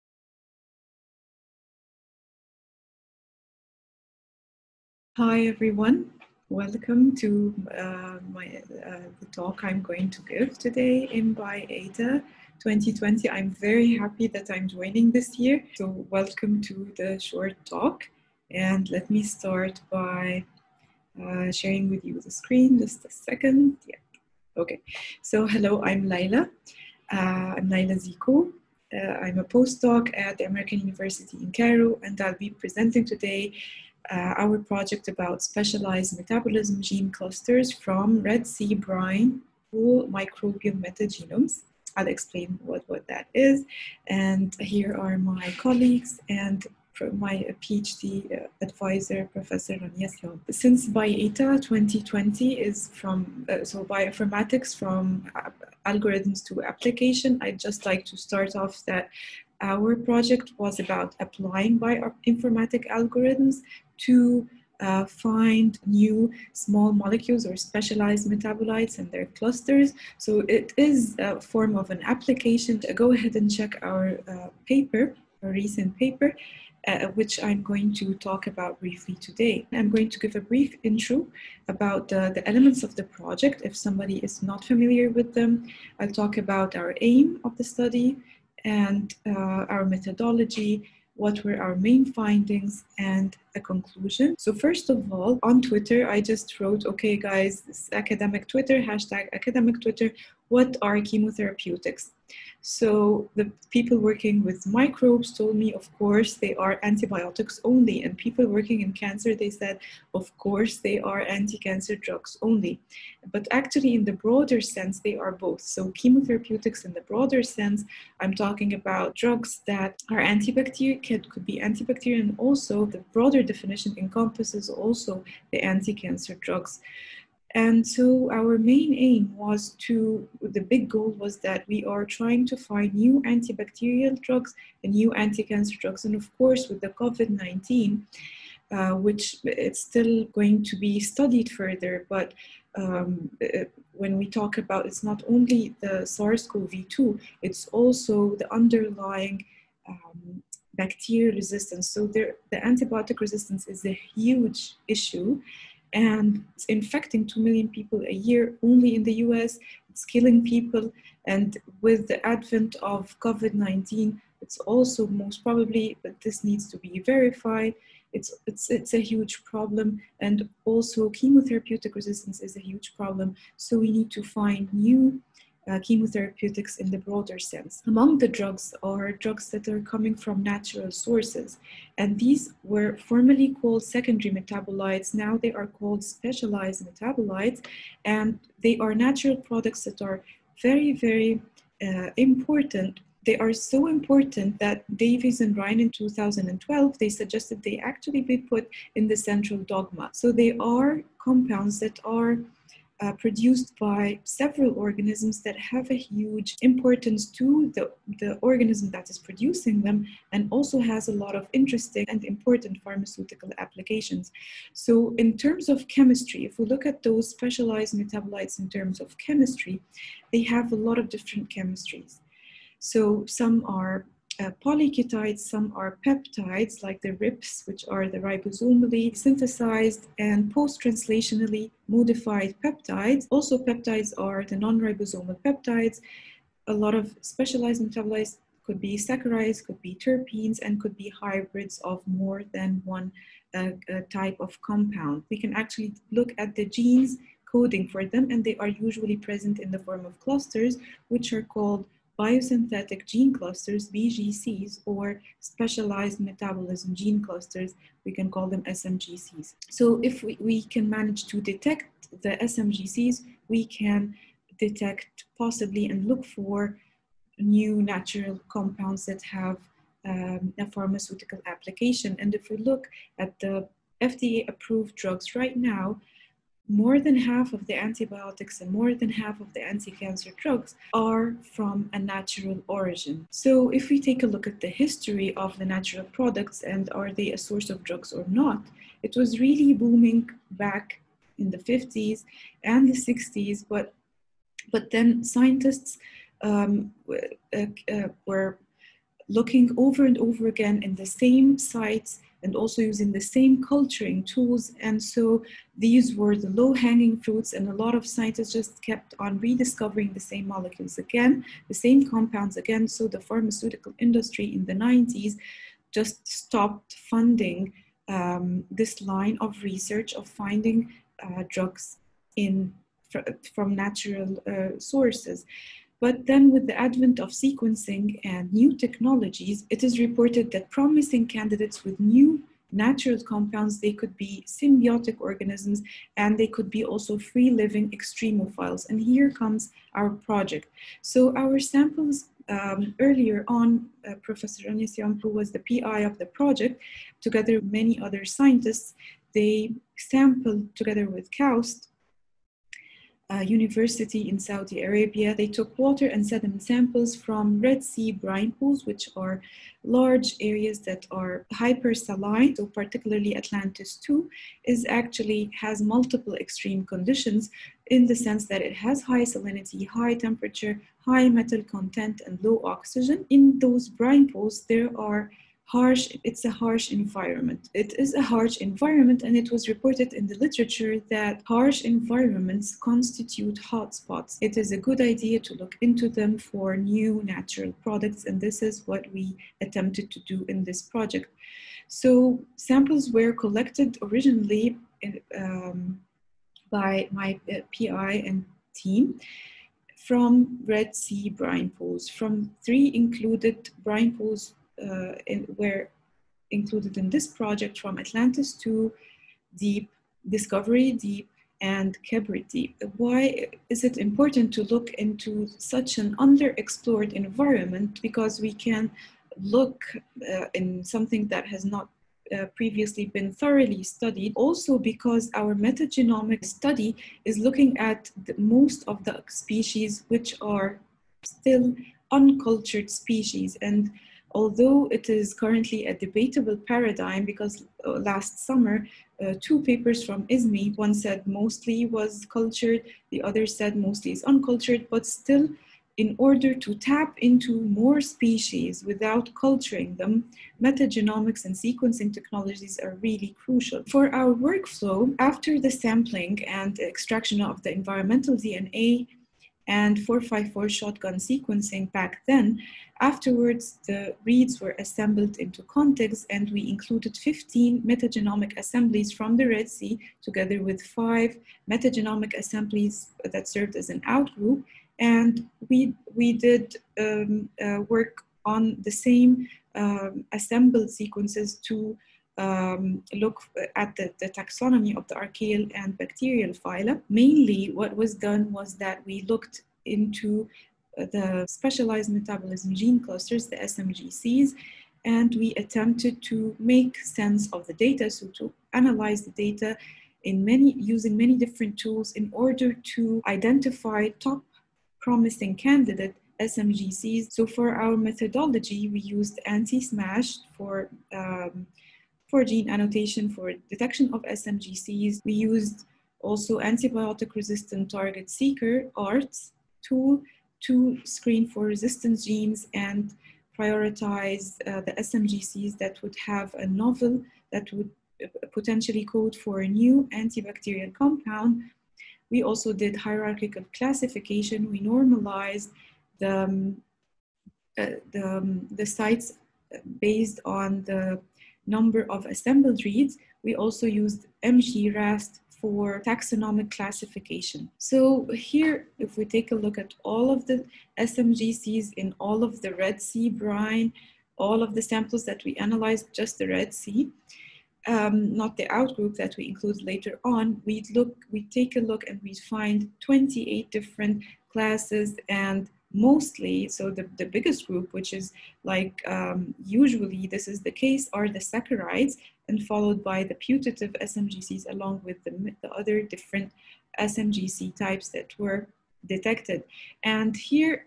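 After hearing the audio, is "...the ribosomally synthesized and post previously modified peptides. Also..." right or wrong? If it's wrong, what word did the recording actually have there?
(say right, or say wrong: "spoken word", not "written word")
wrong: "translationally", not "previously".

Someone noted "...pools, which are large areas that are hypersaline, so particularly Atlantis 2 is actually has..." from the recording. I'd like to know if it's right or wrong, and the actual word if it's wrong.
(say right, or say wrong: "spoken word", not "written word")
right.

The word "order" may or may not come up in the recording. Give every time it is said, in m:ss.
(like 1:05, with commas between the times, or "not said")
7:26, 8:22.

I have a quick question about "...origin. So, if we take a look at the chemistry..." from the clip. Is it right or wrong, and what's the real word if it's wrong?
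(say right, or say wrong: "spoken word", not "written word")
wrong: "history", not "chemistry".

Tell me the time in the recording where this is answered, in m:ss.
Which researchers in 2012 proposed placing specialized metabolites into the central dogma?
3:14.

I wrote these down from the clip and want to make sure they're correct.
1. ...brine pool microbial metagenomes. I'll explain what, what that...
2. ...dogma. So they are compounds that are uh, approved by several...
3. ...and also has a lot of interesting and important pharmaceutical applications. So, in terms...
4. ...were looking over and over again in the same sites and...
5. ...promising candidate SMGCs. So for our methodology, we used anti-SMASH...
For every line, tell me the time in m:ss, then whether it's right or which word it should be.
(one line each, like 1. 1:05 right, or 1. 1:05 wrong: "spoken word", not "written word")
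1. 0:38 right
2. 3:19 wrong: "produced", not "approved"
3. 3:30 right
4. 4:58 right
5. 8:24 right.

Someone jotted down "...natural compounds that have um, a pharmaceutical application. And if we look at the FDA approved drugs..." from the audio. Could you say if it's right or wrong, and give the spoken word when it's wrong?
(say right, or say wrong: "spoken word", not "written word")
right.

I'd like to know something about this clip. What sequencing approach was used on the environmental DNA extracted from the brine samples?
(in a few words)
454 shotgun sequencing.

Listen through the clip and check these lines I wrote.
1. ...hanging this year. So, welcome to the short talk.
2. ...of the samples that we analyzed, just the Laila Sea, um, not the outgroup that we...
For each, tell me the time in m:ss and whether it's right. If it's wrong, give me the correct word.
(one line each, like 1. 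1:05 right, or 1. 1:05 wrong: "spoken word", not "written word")
1. 0:14 wrong: "joining", not "hanging"
2. 9:14 wrong: "Red", not "Laila".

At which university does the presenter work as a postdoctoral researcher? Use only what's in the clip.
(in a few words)
American University in Cairo.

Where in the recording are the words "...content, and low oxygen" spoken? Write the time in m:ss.
6:11.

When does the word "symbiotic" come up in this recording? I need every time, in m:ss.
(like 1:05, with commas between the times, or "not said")
5:34.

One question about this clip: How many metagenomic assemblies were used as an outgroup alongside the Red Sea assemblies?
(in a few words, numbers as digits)
5.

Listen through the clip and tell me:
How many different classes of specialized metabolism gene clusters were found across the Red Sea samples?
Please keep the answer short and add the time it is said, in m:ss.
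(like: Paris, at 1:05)
28, at 9:23.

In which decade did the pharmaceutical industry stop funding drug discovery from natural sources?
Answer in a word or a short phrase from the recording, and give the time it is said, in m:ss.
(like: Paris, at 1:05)
the 90s, at 5:14.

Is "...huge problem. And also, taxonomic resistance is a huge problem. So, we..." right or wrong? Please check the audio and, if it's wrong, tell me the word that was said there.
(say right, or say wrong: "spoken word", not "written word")
wrong: "chemotherapeutic", not "taxonomic".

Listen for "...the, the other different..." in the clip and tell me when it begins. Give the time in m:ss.
9:35.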